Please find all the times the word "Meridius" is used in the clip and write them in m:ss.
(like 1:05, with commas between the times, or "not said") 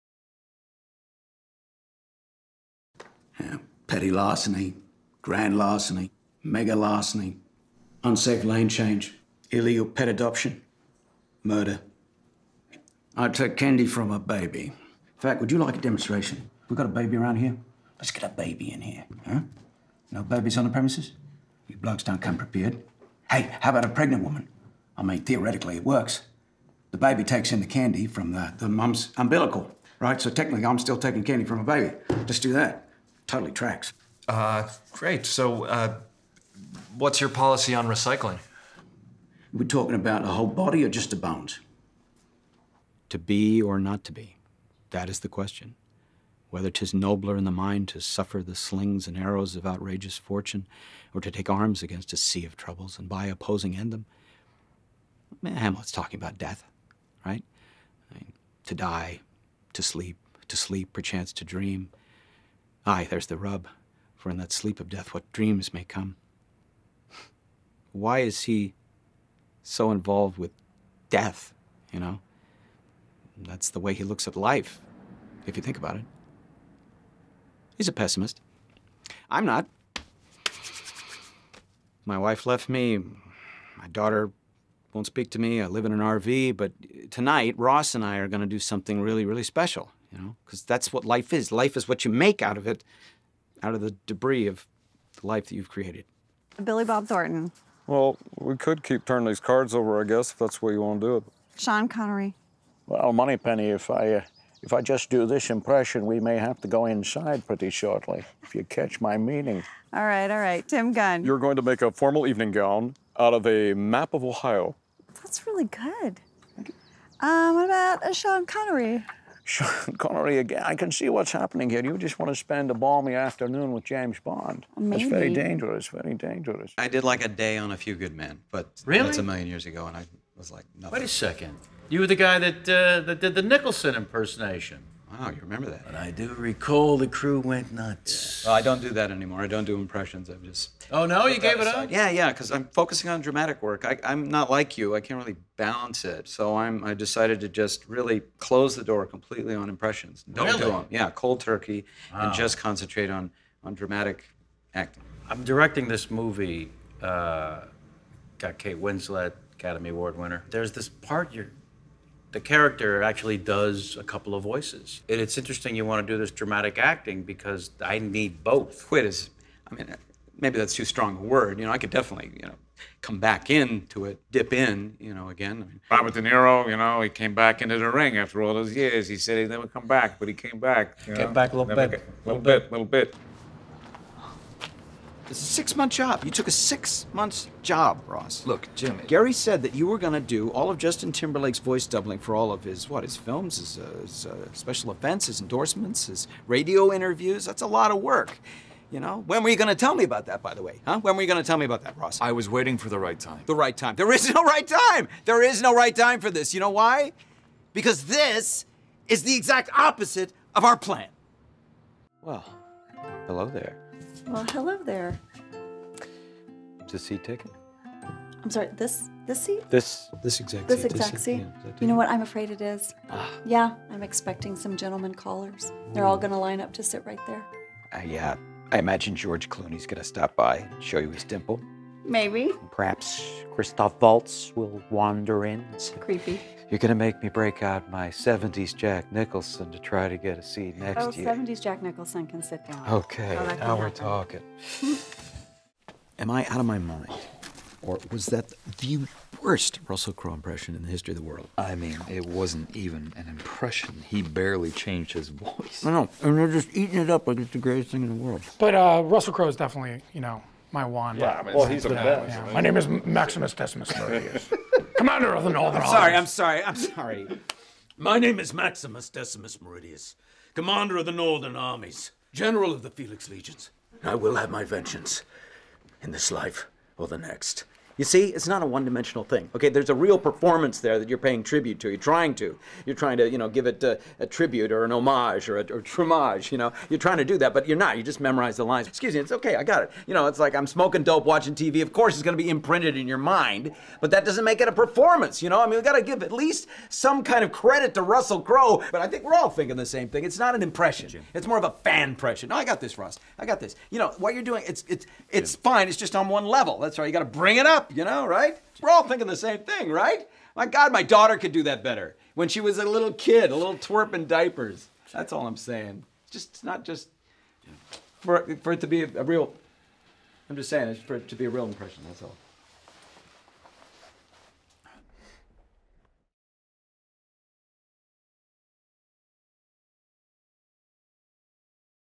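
4:23, 4:29.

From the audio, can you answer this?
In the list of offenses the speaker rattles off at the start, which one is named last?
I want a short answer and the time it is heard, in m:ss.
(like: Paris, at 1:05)
Murder, at 0:11.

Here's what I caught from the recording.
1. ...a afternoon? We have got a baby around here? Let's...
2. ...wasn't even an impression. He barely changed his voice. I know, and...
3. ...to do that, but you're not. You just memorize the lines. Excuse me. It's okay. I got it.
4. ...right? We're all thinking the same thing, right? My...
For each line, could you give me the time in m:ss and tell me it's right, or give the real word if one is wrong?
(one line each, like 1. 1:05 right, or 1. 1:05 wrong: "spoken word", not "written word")
1. 0:15 wrong: "demonstration", not "afternoon"
2. 4:12 right
3. 4:47 right
4. 5:08 right.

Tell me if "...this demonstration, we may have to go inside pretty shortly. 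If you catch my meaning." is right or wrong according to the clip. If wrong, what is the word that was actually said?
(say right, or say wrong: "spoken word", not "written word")
wrong: "impression", not "demonstration".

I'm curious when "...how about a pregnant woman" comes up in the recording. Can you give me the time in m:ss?
0:23.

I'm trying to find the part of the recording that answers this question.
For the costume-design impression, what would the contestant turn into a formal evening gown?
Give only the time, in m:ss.
1:53.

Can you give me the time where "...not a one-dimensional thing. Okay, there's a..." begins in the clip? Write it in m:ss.
4:38.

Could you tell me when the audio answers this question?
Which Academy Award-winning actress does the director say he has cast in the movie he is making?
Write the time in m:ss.
2:38.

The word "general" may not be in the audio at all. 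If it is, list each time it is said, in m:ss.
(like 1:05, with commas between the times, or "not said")
4:32.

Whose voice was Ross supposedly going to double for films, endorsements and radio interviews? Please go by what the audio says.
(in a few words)
Justin Timberlake.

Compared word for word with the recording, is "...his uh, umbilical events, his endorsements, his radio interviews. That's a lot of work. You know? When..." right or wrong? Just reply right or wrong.
wrong.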